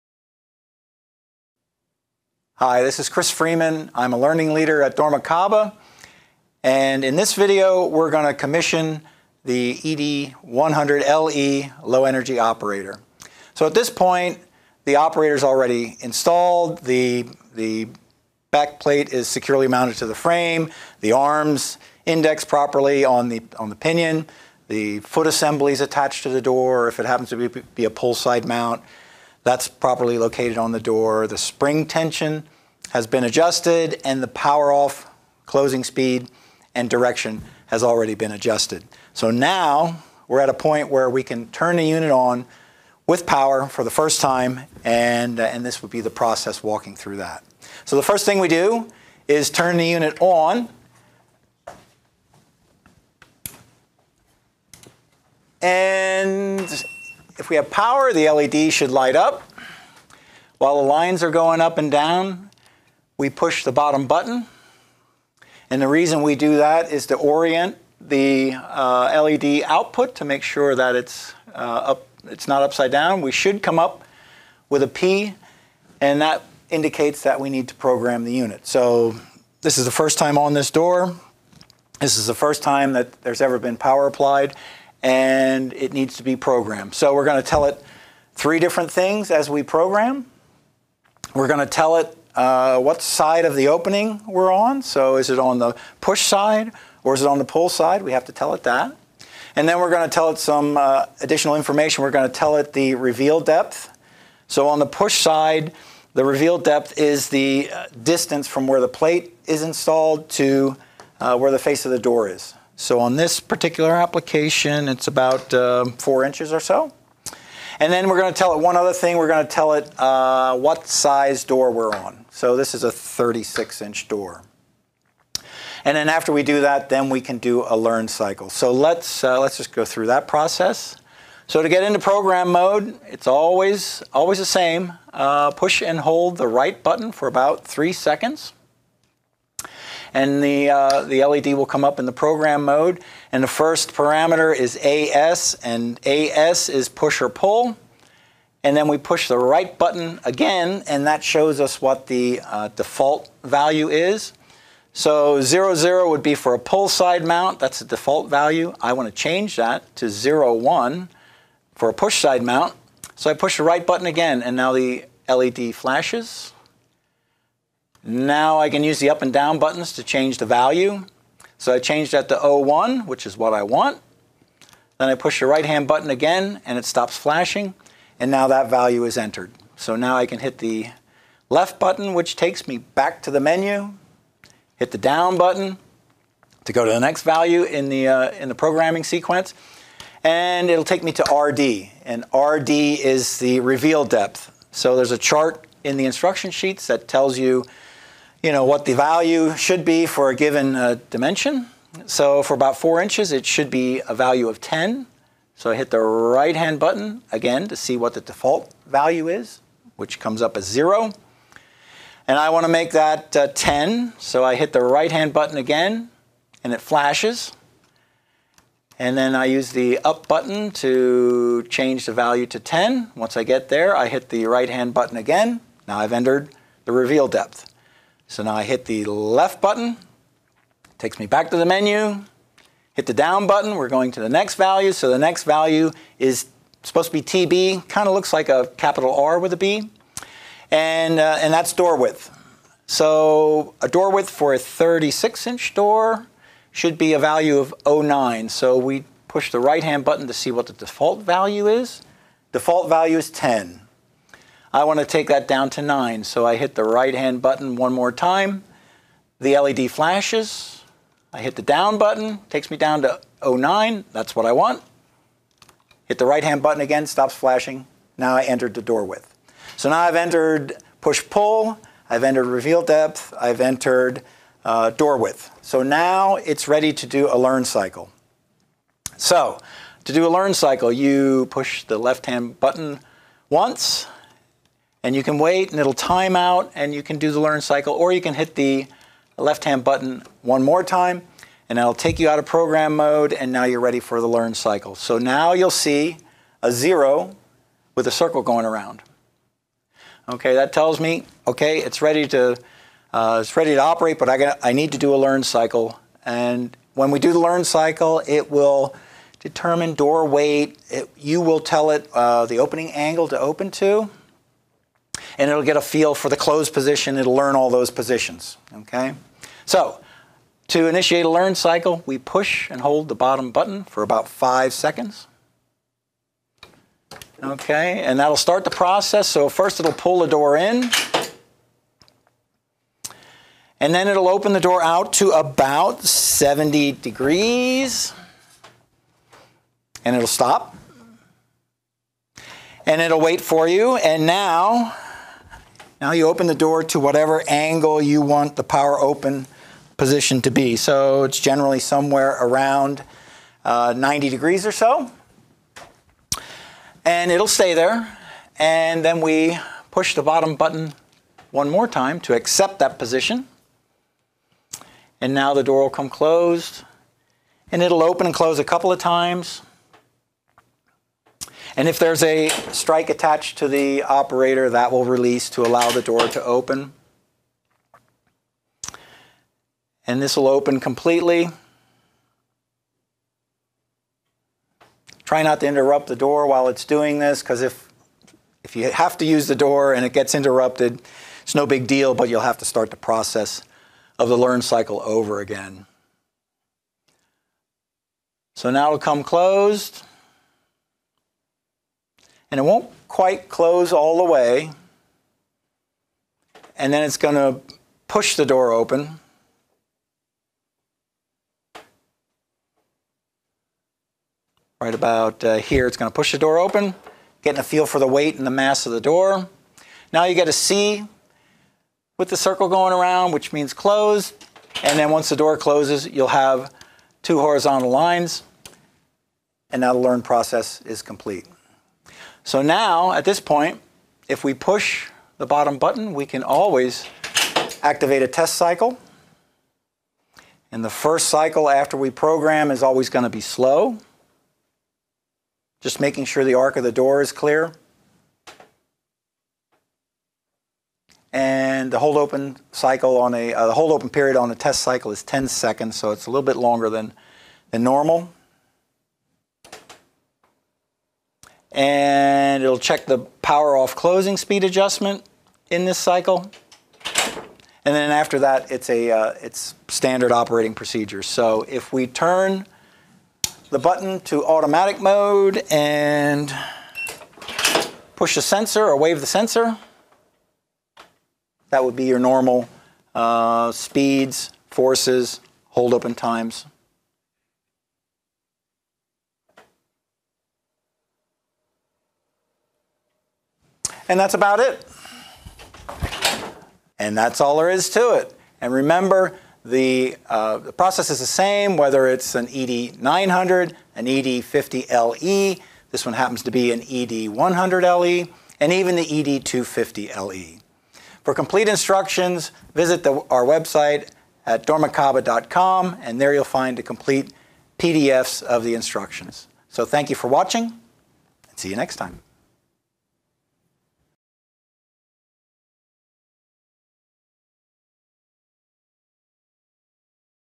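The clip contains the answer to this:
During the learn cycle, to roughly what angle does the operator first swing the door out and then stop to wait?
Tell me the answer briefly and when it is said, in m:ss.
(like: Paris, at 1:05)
70 degrees, at 5:36.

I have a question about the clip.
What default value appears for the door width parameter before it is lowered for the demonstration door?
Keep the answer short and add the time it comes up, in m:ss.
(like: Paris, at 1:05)
10, at 4:12.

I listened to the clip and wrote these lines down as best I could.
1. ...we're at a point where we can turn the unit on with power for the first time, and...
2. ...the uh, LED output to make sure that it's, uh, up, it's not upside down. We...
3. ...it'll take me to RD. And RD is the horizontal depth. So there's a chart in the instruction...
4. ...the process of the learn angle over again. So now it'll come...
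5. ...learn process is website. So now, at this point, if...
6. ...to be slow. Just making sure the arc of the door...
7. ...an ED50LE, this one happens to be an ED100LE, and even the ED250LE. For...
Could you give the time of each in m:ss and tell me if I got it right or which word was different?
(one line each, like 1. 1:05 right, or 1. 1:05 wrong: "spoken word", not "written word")
1. 0:40 right
2. 1:07 right
3. 3:10 wrong: "reveal", not "horizontal"
4. 6:32 wrong: "cycle", not "angle"
5. 7:09 wrong: "complete", not "website"
6. 7:23 right
7. 8:23 right.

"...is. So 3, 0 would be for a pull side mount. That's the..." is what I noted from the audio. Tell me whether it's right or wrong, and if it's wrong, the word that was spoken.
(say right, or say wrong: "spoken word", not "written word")
wrong: "0", not "3".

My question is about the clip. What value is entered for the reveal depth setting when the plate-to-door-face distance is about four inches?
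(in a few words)
10.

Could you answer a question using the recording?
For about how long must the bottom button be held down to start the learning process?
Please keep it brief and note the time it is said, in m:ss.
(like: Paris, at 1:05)
5 seconds, at 5:24.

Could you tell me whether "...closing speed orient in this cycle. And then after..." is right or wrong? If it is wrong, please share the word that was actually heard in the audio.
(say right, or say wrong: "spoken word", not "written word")
wrong: "adjustment", not "orient".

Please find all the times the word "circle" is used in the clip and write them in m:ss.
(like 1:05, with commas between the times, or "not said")
4:58, 7:02.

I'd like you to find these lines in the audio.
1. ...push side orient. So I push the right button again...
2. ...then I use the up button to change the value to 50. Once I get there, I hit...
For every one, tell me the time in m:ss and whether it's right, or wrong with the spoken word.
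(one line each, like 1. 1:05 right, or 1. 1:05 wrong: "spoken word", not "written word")
1. 2:41 wrong: "mount", not "orient"
2. 3:39 wrong: "10", not "50".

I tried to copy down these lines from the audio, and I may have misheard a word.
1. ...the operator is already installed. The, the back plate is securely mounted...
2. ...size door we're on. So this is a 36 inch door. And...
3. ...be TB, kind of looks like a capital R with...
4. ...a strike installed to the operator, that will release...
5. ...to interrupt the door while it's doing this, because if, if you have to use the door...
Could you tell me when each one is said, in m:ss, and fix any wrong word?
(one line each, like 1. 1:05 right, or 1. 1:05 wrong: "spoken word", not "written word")
1. 0:14 right
2. 2:00 right
3. 3:57 right
4. 6:12 wrong: "attached", not "installed"
5. 6:25 right.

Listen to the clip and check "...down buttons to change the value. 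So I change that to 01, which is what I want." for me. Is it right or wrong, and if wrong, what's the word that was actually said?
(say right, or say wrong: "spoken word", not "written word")
right.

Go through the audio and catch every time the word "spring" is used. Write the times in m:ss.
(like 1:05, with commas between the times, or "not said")
0:31.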